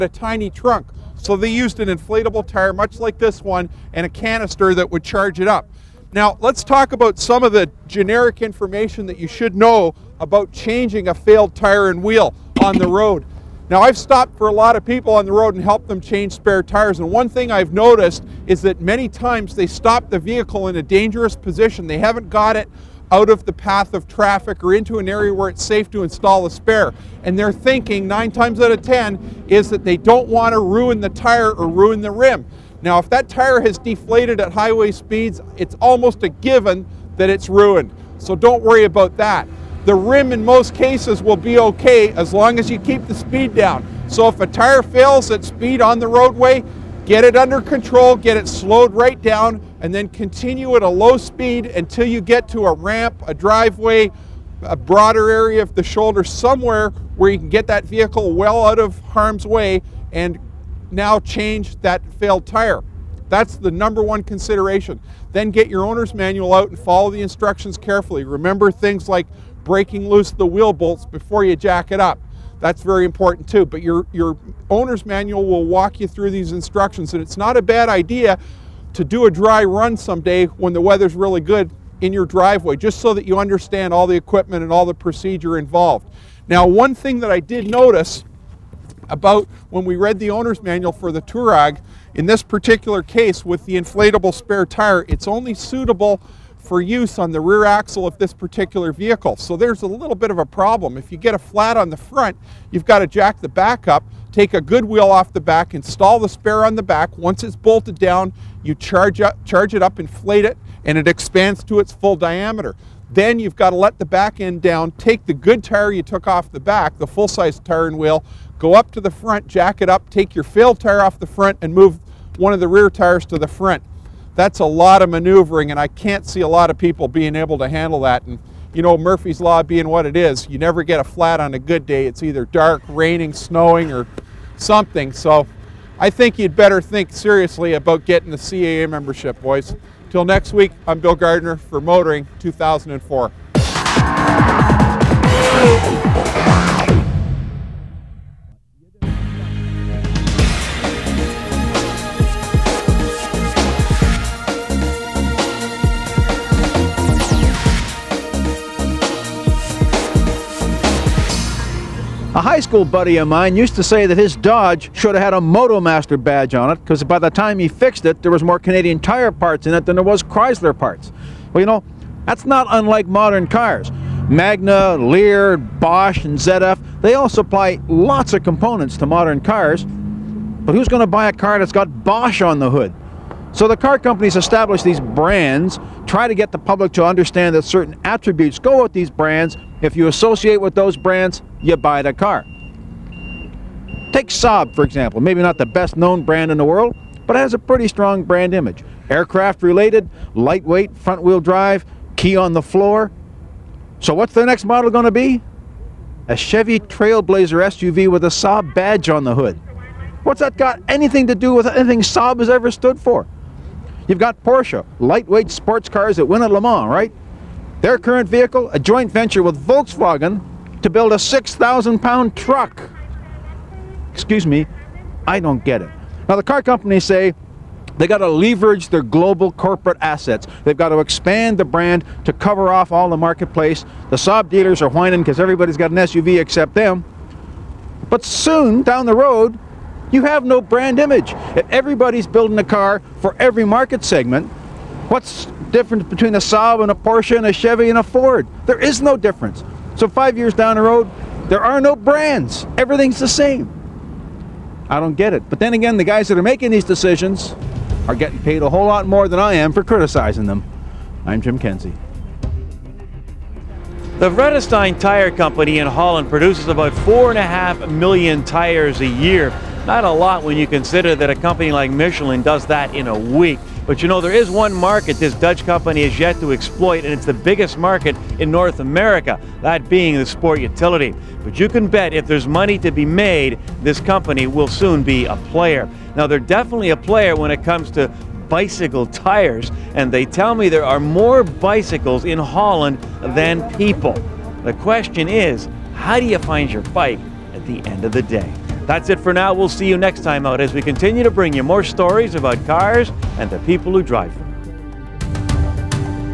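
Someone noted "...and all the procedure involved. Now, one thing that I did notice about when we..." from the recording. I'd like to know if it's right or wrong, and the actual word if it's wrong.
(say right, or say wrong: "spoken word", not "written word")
right.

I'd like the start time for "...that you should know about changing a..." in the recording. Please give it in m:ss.
0:09.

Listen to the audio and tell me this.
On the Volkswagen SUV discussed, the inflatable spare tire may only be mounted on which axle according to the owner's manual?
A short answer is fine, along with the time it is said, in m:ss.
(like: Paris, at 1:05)
Rear axle, at 1:37.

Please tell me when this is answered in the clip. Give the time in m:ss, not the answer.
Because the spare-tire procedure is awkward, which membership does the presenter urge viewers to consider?
2:18.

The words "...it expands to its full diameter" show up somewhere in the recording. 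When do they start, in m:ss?
1:50.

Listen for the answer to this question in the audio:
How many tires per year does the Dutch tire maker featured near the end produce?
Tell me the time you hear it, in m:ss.
4:26.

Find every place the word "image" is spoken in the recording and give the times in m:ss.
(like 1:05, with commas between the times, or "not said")
3:18, 4:00.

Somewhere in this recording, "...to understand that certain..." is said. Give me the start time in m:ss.
3:06.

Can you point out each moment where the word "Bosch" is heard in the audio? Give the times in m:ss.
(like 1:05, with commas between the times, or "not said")
2:55, 3:02.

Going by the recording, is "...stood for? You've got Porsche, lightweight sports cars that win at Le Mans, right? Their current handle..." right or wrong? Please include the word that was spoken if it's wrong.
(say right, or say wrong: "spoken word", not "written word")
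wrong: "vehicle", not "handle".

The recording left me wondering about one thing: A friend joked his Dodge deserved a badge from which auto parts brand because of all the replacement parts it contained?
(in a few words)
Motomaster.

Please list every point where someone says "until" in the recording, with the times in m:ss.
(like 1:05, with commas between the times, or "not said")
0:51.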